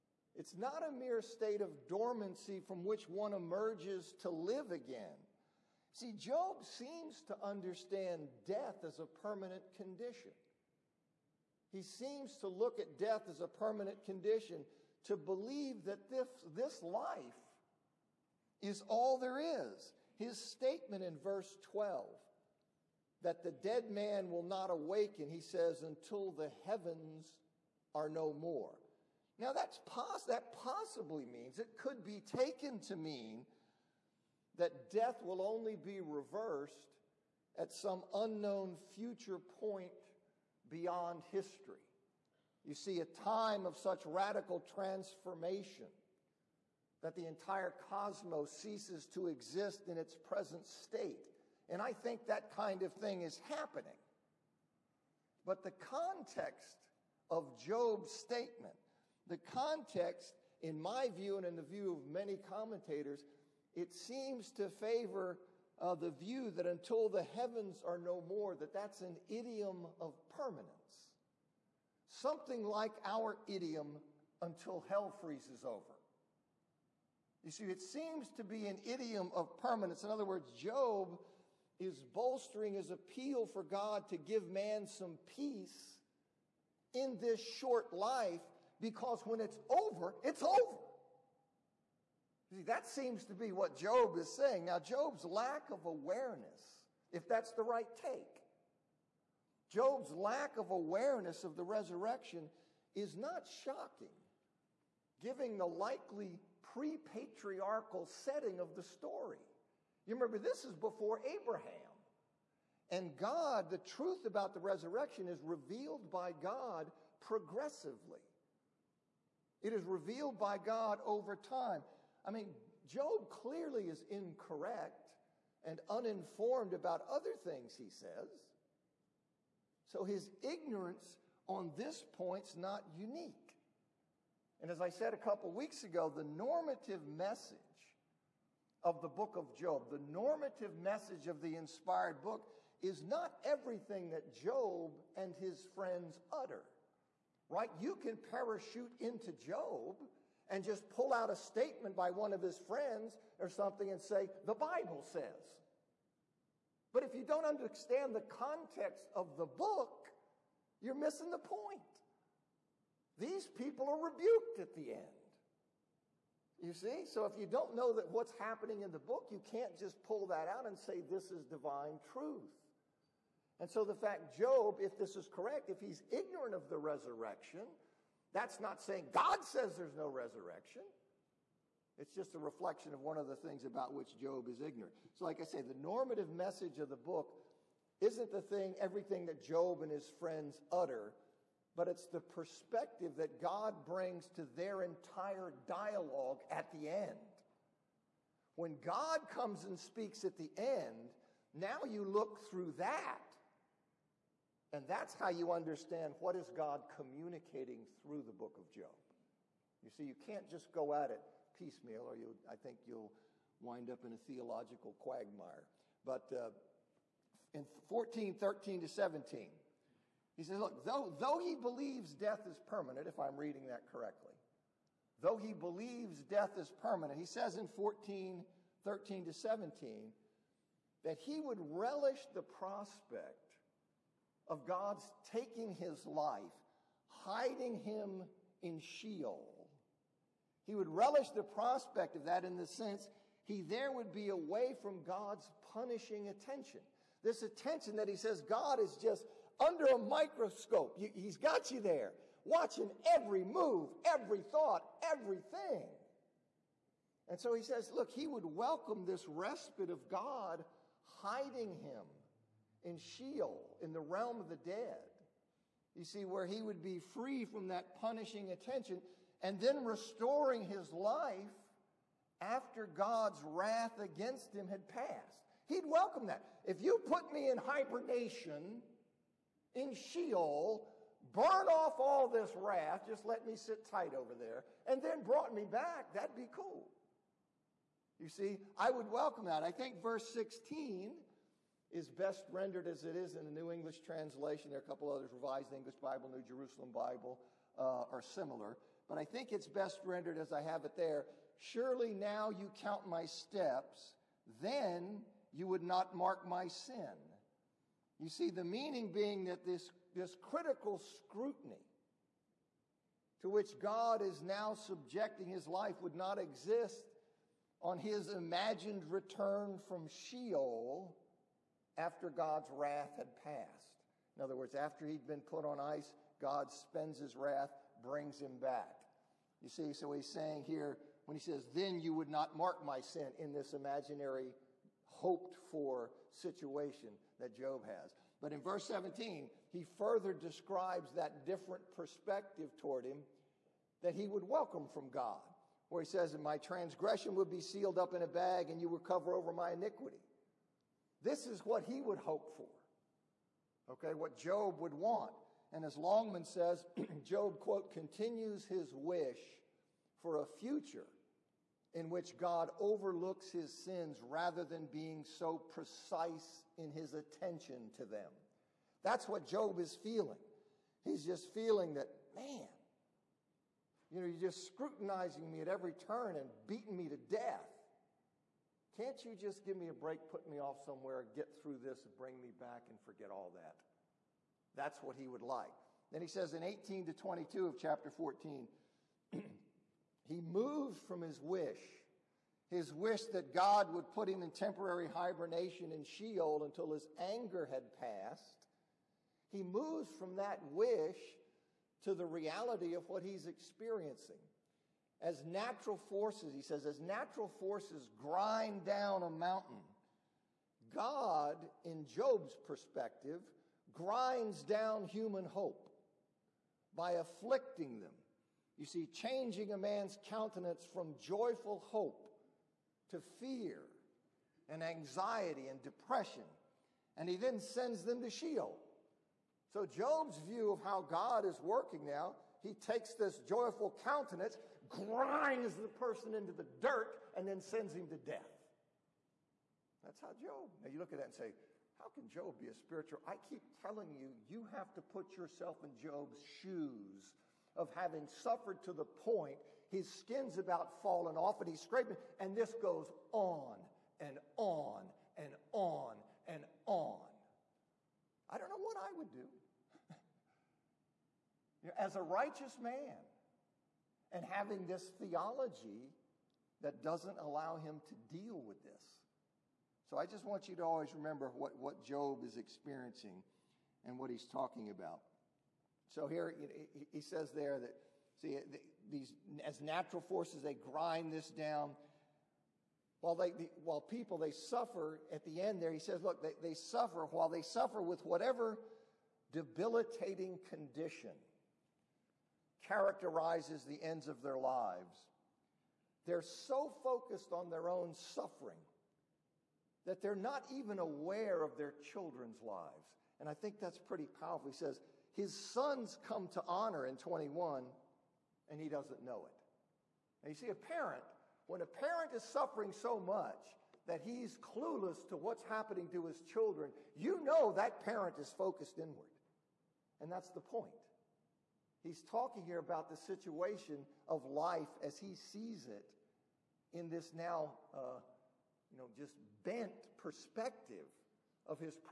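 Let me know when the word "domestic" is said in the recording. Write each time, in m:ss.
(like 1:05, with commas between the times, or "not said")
not said.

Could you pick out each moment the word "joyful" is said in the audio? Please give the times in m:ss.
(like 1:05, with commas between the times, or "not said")
7:01, 7:13.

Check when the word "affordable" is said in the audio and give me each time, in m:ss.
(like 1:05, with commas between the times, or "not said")
not said.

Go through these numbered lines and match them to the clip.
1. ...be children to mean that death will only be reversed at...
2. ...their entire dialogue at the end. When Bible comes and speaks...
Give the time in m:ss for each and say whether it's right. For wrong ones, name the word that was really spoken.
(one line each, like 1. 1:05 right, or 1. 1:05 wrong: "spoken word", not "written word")
1. 0:32 wrong: "taken", not "children"
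2. 3:14 wrong: "God", not "Bible".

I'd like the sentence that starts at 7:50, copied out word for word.
So I just want you to always remember what, what Job is experiencing and what he's talking about.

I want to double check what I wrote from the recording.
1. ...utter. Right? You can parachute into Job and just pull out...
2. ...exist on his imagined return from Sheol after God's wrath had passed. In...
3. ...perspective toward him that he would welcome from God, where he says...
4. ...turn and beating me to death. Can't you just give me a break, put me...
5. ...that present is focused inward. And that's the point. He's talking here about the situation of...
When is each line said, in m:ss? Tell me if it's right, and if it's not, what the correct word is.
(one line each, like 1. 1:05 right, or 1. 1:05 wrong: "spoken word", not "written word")
1. 2:26 right
2. 5:16 right
3. 5:41 right
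4. 6:15 right
5. 8:37 wrong: "parent", not "present".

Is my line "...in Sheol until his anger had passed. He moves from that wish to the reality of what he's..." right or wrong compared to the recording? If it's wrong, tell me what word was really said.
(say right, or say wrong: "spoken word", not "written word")
right.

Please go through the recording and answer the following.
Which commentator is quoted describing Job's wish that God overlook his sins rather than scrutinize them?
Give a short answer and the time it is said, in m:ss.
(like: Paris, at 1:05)
Longman, at 5:55.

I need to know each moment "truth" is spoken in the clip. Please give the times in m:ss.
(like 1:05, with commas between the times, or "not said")
1:53, 2:51.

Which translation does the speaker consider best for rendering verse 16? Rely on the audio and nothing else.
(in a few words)
New English translation.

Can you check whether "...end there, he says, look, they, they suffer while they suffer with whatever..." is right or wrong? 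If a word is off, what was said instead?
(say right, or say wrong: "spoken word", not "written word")
right.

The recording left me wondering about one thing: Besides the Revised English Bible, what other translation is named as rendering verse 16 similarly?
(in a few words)
New Jerusalem Bible.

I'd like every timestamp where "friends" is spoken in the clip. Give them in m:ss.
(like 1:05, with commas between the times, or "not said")
2:25, 2:32, 3:10.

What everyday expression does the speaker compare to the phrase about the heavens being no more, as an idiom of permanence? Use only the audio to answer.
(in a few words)
until hell freezes over.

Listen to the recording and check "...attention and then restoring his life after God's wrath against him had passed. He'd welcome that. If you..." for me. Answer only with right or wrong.
right.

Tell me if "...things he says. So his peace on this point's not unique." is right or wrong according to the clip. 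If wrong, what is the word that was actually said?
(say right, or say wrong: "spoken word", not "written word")
wrong: "ignorance", not "peace".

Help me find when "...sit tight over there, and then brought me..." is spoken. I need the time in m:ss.
4:43.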